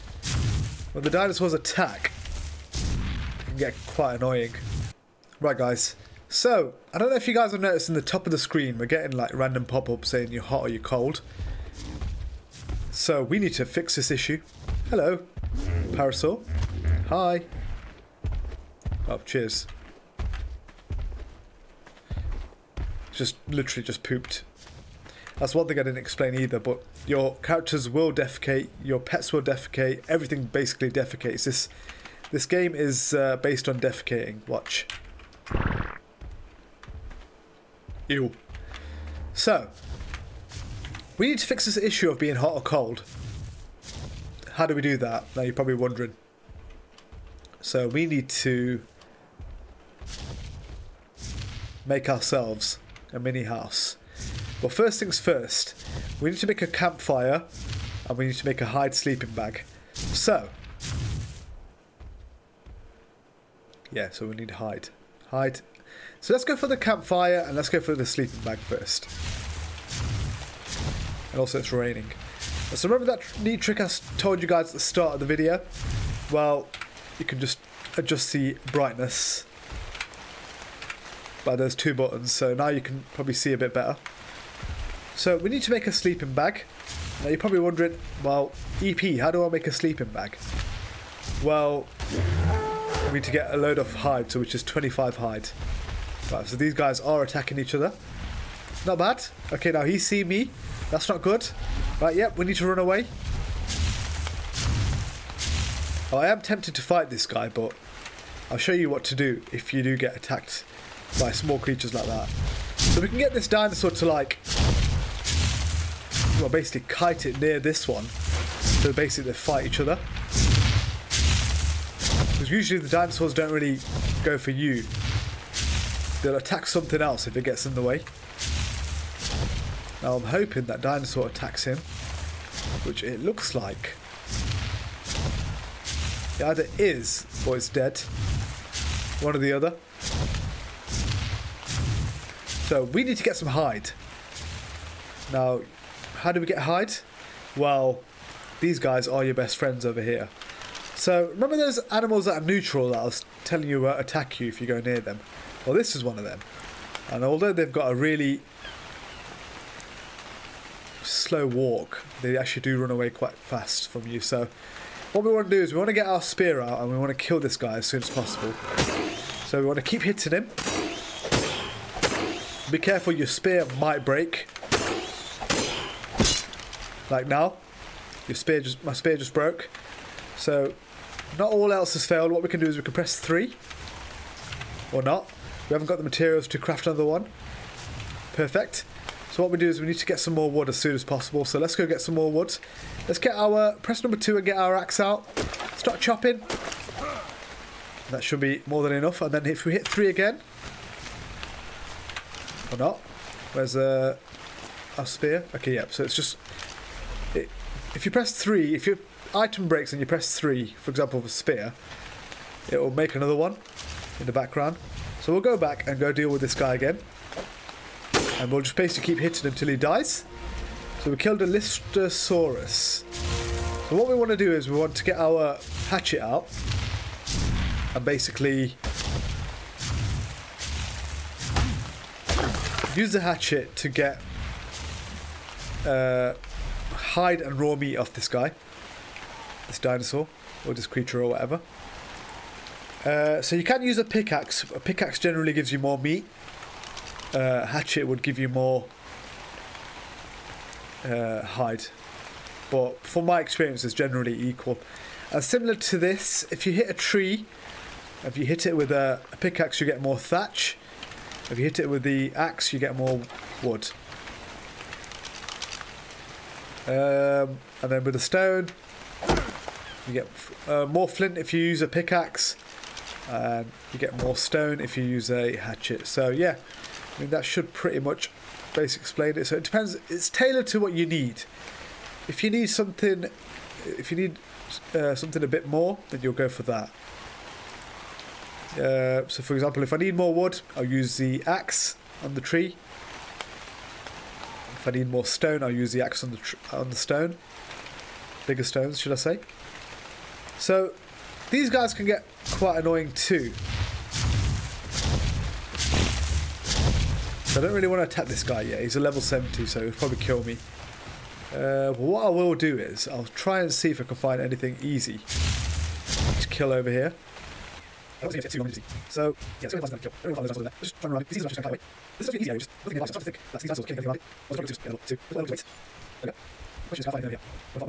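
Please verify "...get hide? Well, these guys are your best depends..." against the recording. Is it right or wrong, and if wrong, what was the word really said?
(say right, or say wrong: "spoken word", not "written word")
wrong: "friends", not "depends".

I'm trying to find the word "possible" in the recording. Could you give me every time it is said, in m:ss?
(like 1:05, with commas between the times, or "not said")
2:48, 3:11.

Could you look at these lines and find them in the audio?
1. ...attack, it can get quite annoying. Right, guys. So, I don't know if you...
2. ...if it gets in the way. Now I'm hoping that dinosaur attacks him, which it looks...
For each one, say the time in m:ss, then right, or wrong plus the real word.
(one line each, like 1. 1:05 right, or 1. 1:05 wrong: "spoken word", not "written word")
1. 0:01 right
2. 2:07 right.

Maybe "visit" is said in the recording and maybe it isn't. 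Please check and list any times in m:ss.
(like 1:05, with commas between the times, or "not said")
not said.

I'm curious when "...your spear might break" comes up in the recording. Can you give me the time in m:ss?
2:53.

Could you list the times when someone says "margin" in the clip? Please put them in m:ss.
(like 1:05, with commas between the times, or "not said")
not said.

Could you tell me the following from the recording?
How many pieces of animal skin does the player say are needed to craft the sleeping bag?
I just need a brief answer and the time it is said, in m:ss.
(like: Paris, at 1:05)
25, at 1:34.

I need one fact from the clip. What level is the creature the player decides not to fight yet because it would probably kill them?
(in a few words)
70.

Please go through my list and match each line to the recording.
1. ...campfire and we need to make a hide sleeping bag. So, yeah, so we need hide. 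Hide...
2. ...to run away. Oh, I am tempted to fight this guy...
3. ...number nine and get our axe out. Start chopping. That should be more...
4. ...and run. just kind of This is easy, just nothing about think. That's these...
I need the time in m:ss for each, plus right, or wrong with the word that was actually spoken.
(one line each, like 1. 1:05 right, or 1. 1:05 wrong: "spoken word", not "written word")
1. 0:56 right
2. 1:42 right
3. 3:14 wrong: "two", not "nine"
4. 5:21 right.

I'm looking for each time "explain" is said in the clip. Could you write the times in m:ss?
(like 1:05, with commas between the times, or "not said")
0:25, 4:39.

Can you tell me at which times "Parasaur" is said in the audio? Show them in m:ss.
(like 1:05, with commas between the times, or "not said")
0:15.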